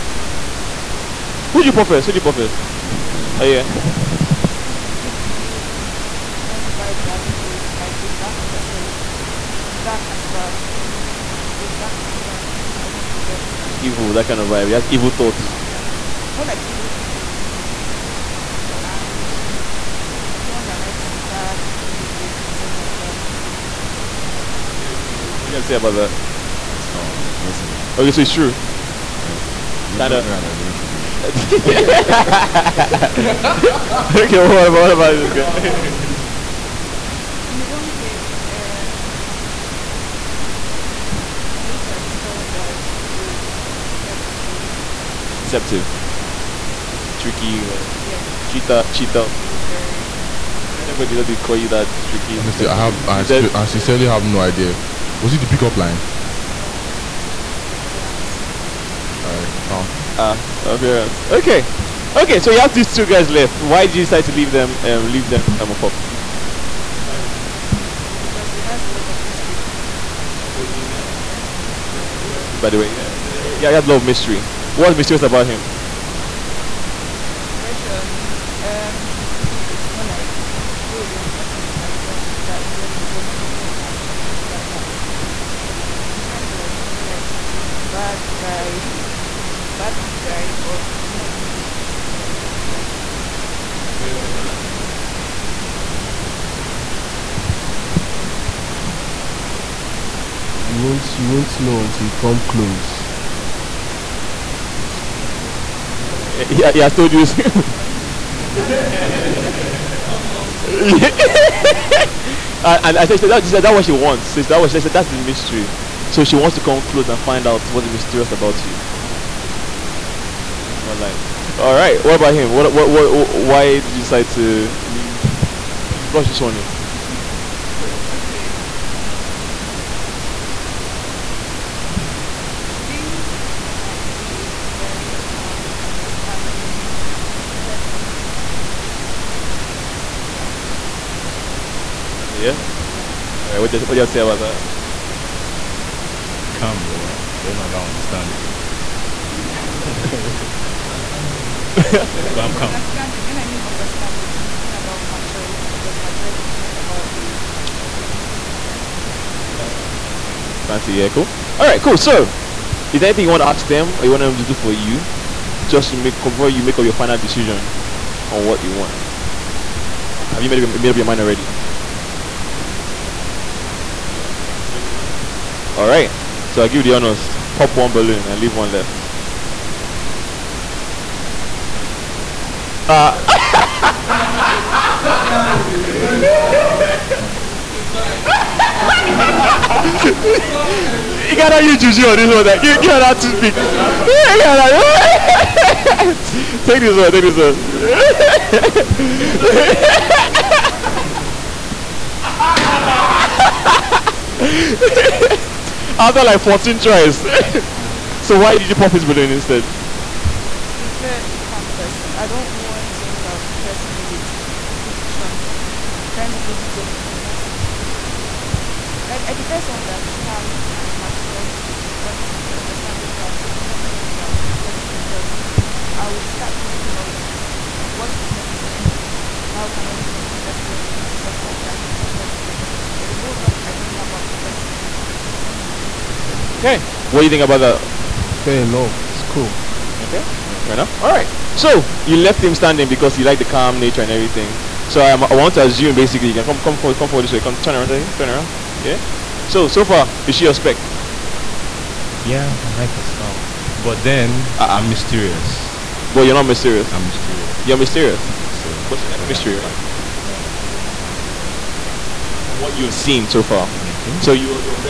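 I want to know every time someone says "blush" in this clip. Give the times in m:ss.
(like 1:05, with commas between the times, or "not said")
2:06.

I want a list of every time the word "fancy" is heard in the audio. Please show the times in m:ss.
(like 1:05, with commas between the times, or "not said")
2:40.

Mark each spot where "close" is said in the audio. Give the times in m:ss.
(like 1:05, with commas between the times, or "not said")
1:42, 1:56.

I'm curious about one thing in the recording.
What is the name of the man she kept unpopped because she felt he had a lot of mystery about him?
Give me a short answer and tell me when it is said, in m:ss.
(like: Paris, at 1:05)
Wesley, at 1:12.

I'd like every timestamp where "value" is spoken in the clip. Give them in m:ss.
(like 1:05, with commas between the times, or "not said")
not said.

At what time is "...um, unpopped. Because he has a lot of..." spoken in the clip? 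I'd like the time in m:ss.
1:05.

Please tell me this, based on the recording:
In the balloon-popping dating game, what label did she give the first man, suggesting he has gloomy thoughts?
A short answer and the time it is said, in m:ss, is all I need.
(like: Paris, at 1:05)
dark thinker, at 0:11.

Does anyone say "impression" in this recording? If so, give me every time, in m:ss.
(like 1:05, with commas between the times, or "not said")
1:17.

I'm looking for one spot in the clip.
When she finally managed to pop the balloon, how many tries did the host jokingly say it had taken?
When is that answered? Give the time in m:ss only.
3:26.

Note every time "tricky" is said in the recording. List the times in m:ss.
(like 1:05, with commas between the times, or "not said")
0:47, 0:51.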